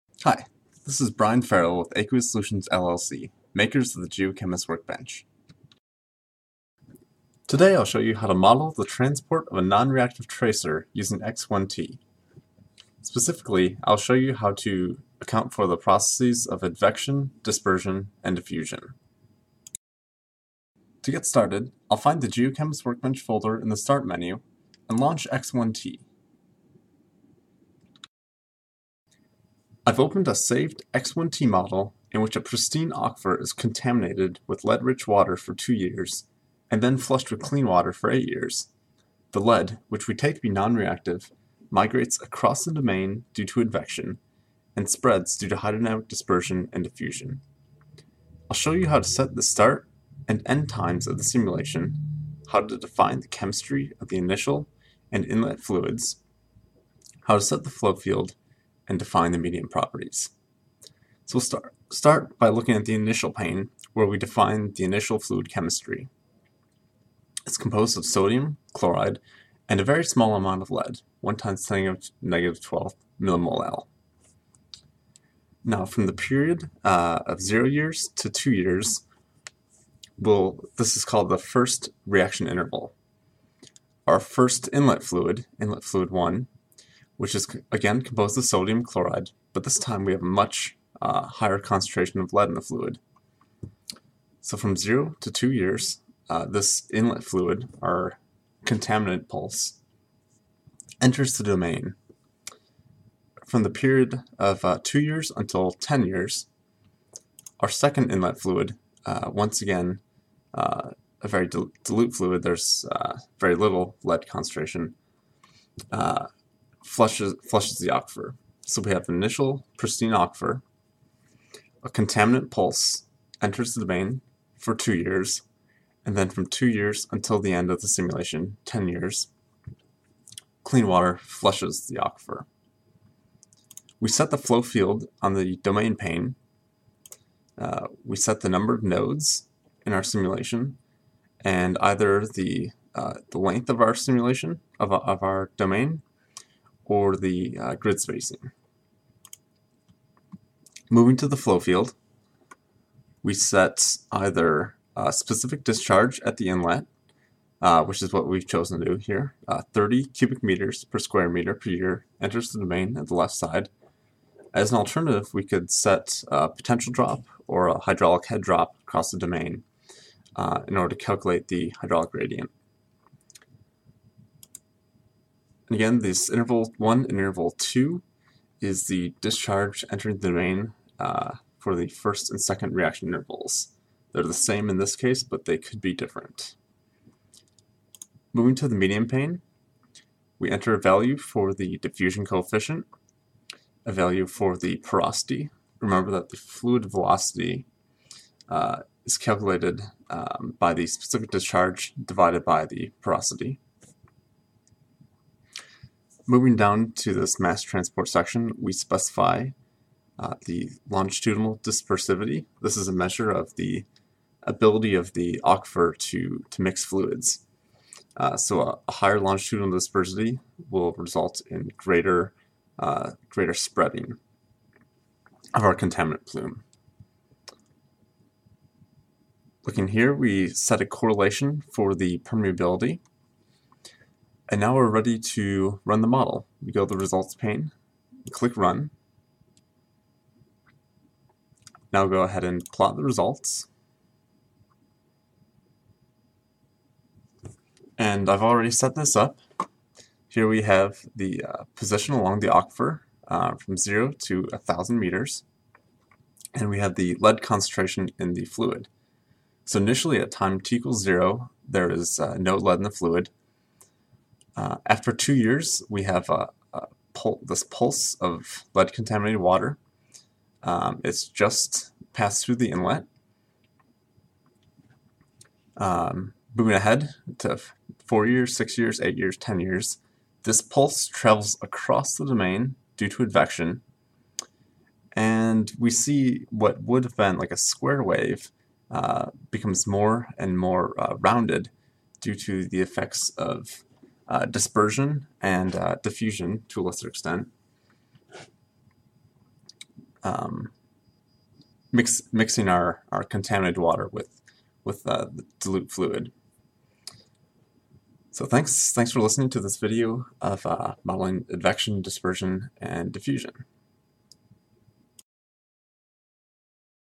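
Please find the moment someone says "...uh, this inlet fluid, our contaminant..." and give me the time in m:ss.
1:36.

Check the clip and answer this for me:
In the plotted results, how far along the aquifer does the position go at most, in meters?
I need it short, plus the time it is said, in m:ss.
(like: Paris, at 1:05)
1,000 meters, at 4:14.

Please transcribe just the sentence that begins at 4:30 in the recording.
Um, it's just passed through the inlet.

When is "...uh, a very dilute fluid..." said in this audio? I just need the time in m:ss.
1:50.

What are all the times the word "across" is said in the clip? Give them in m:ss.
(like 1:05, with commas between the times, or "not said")
0:42, 2:48, 4:41.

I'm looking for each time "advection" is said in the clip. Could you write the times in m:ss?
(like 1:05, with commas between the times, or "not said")
0:16, 0:43, 4:43, 5:11.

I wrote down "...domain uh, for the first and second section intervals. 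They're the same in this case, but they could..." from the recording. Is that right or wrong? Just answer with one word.
wrong.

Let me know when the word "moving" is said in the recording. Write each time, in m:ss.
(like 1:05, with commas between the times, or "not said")
2:30, 3:08, 3:26, 4:36.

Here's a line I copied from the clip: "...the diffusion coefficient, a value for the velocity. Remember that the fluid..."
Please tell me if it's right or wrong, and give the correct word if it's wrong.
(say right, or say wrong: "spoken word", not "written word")
wrong: "porosity", not "velocity".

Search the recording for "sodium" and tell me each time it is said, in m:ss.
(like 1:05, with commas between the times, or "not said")
1:08, 1:28.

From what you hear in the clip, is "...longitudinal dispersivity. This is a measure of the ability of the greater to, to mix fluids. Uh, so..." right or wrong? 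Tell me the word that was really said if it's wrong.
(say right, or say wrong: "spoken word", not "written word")
wrong: "aquifer", not "greater".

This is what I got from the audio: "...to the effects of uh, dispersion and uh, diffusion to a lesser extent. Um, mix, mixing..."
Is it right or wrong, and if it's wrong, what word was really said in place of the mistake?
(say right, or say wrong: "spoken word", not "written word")
right.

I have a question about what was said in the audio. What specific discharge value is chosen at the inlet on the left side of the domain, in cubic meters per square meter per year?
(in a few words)
30.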